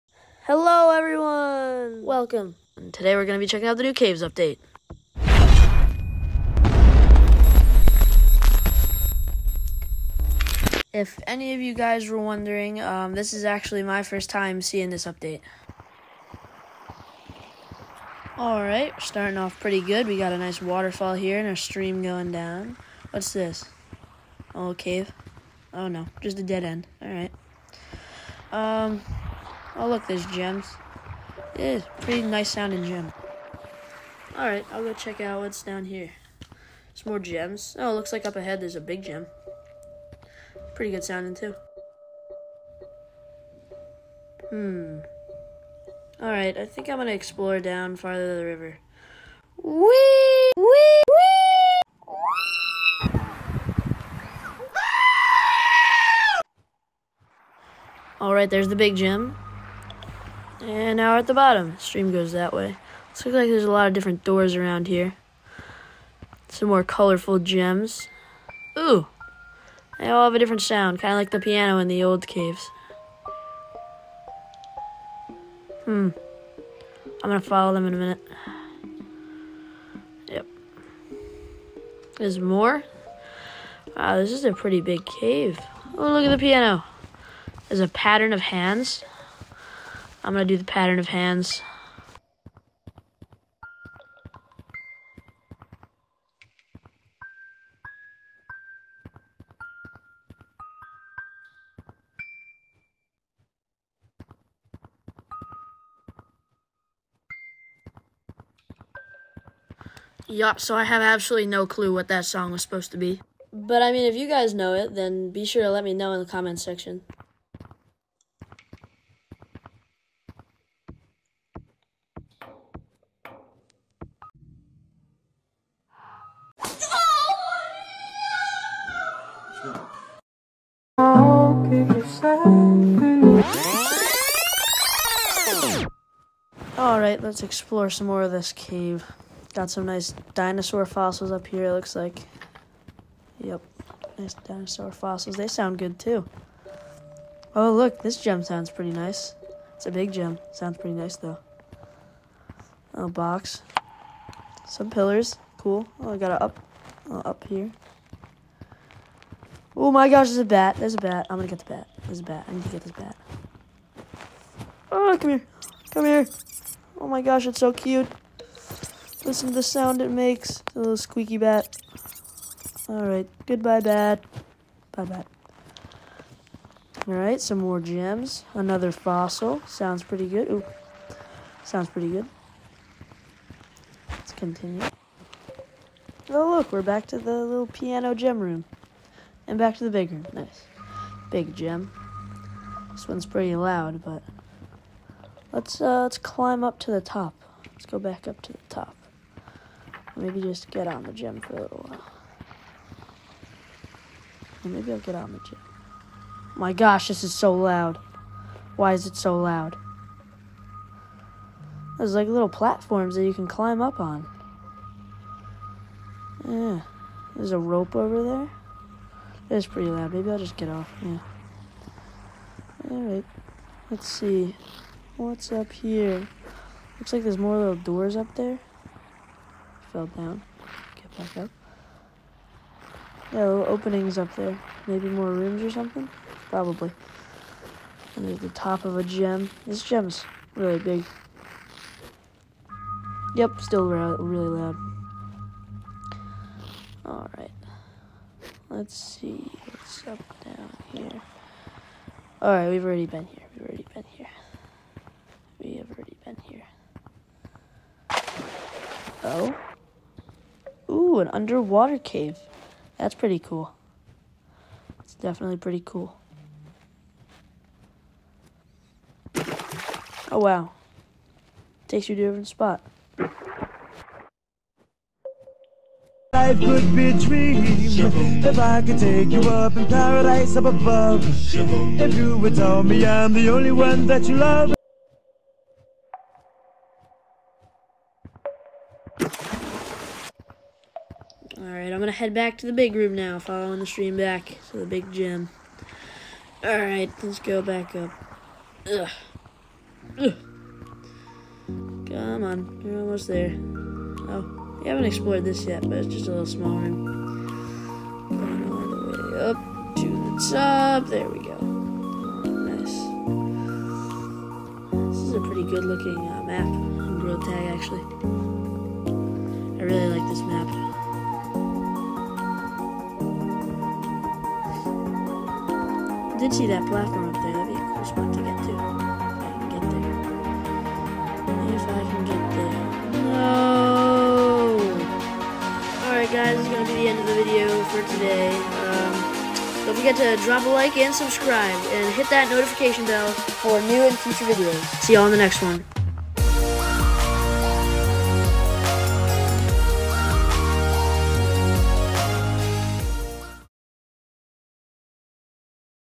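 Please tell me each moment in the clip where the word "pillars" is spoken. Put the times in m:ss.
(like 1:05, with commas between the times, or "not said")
2:34.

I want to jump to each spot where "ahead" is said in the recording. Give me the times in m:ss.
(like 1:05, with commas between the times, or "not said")
0:38.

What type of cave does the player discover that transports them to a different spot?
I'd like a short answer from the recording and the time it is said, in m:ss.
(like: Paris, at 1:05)
An underwater cave, at 4:21.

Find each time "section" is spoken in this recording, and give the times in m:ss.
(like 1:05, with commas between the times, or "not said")
1:56.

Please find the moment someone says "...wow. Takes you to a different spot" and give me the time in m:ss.
4:30.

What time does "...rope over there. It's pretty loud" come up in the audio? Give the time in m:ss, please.
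3:37.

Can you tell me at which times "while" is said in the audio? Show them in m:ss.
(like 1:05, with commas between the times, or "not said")
3:21.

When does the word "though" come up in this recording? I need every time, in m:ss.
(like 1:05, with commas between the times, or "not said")
2:31.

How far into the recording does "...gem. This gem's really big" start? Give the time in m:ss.
3:59.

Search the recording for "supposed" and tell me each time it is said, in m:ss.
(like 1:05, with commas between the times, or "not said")
1:52.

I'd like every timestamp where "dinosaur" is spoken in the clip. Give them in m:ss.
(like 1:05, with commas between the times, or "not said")
2:20, 2:24.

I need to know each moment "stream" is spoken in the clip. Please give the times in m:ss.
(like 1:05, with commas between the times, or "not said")
0:21, 1:01, 4:53.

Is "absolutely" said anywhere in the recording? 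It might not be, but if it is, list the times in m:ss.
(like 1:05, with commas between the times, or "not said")
1:51.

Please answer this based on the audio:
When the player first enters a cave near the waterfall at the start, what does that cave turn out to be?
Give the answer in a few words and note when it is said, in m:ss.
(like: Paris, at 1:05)
A dead end, at 0:26.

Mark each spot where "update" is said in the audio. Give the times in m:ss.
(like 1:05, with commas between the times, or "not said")
0:04, 0:15.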